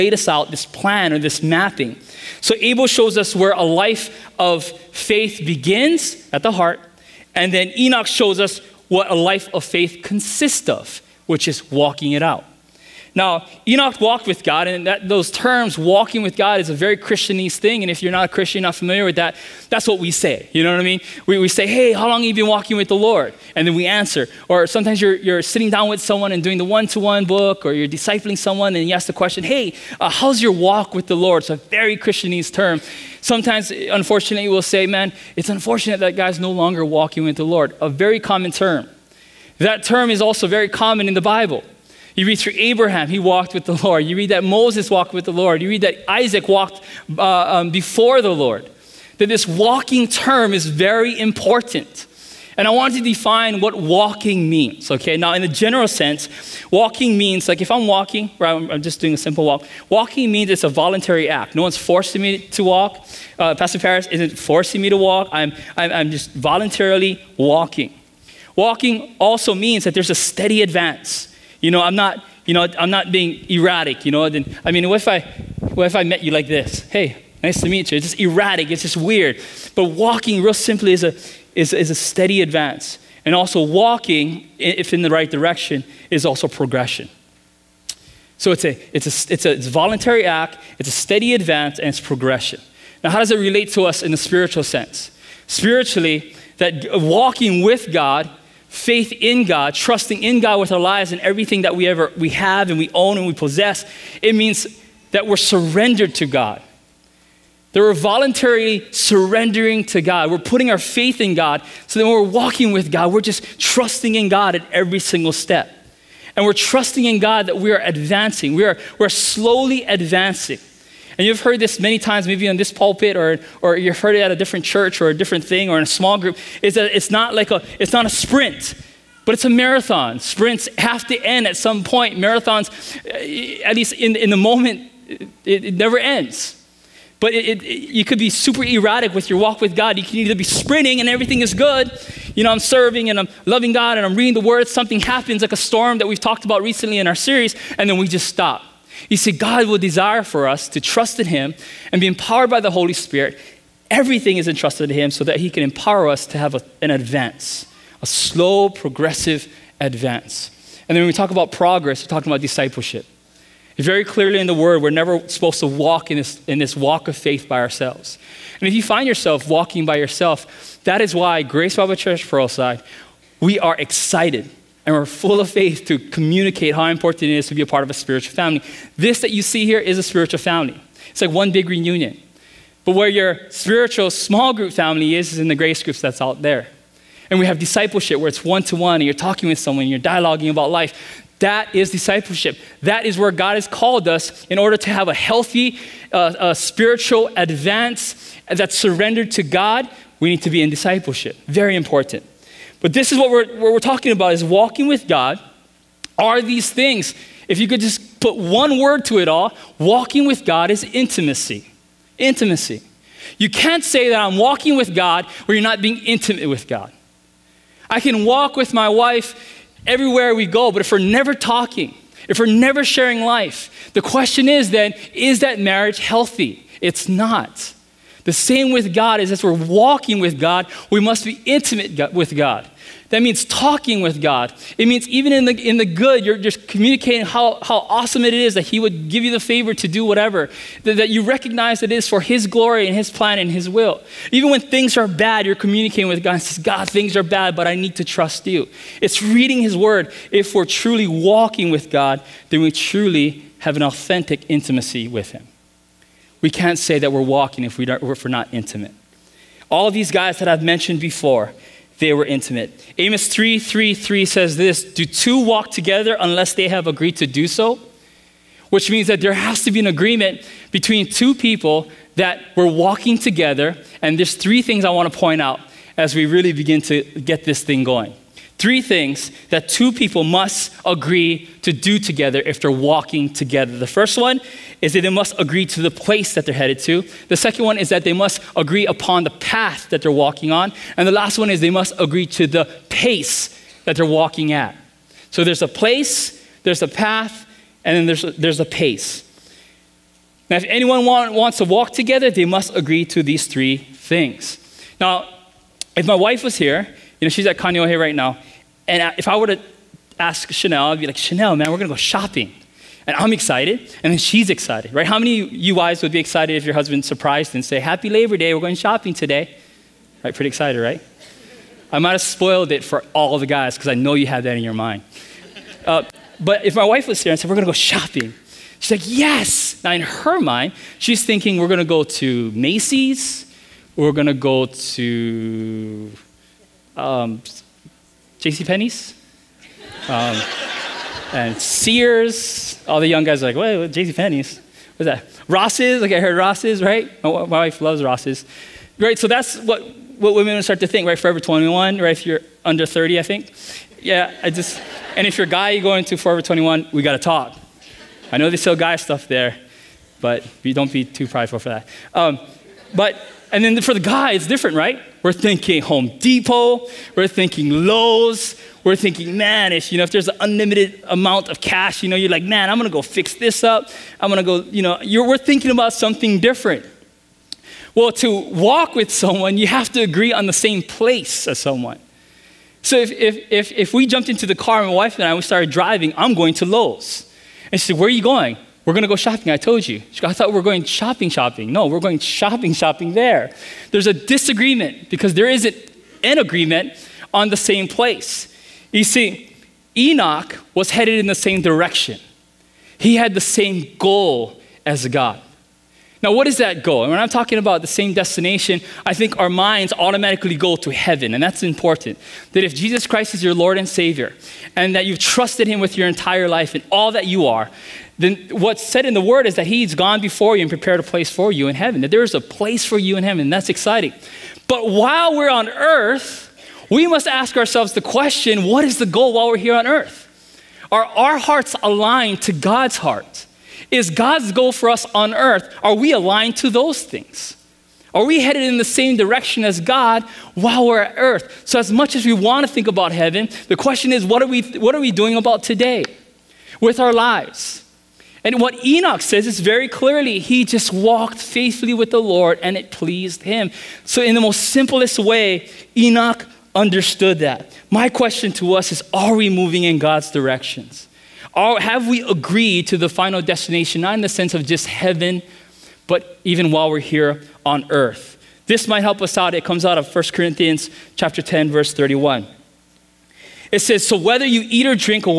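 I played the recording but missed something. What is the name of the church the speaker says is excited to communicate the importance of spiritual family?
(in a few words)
Grace Bible Church Pearlside.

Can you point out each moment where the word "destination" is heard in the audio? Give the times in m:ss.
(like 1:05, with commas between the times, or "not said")
6:48, 7:43.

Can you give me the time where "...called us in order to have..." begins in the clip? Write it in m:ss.
3:13.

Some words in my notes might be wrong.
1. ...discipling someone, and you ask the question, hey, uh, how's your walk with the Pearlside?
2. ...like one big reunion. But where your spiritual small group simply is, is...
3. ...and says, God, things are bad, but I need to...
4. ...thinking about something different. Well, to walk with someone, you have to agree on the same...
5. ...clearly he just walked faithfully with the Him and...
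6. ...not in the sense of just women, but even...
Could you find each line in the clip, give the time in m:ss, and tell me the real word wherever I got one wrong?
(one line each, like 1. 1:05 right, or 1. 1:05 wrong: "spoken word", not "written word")
1. 0:27 wrong: "Lord", not "Pearlside"
2. 3:01 wrong: "family", not "simply"
3. 4:06 right
4. 6:15 right
5. 7:29 wrong: "Lord", not "Him"
6. 7:44 wrong: "heaven", not "women".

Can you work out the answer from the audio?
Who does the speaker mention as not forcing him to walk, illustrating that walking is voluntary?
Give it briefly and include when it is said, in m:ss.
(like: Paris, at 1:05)
Pastor Paris, at 1:03.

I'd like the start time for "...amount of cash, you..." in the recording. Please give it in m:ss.
6:11.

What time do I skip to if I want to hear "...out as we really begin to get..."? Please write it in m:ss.
4:35.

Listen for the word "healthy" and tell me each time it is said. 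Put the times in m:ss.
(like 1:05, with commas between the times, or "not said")
3:15, 3:45.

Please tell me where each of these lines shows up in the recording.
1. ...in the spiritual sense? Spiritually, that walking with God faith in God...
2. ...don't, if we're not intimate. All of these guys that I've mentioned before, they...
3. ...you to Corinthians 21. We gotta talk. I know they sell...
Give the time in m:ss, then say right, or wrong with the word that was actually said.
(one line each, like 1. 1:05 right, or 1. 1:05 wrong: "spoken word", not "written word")
1. 1:34 right
2. 4:17 right
3. 5:55 wrong: "Forever", not "Corinthians".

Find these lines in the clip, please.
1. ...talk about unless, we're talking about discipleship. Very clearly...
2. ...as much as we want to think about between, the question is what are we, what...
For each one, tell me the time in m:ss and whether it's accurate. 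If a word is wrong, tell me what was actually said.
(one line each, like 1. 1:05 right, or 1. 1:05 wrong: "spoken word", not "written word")
1. 2:41 wrong: "progress", not "unless"
2. 7:21 wrong: "heaven", not "between".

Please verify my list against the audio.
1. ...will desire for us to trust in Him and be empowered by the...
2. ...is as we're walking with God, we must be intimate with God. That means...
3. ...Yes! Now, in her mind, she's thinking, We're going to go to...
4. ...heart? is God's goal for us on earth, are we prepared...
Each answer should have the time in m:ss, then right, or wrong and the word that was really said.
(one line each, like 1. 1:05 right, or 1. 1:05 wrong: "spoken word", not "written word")
1. 2:29 right
2. 3:49 right
3. 5:29 right
4. 7:12 wrong: "aligned", not "prepared".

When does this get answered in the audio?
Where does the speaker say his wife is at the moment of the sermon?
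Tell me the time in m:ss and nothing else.
5:07.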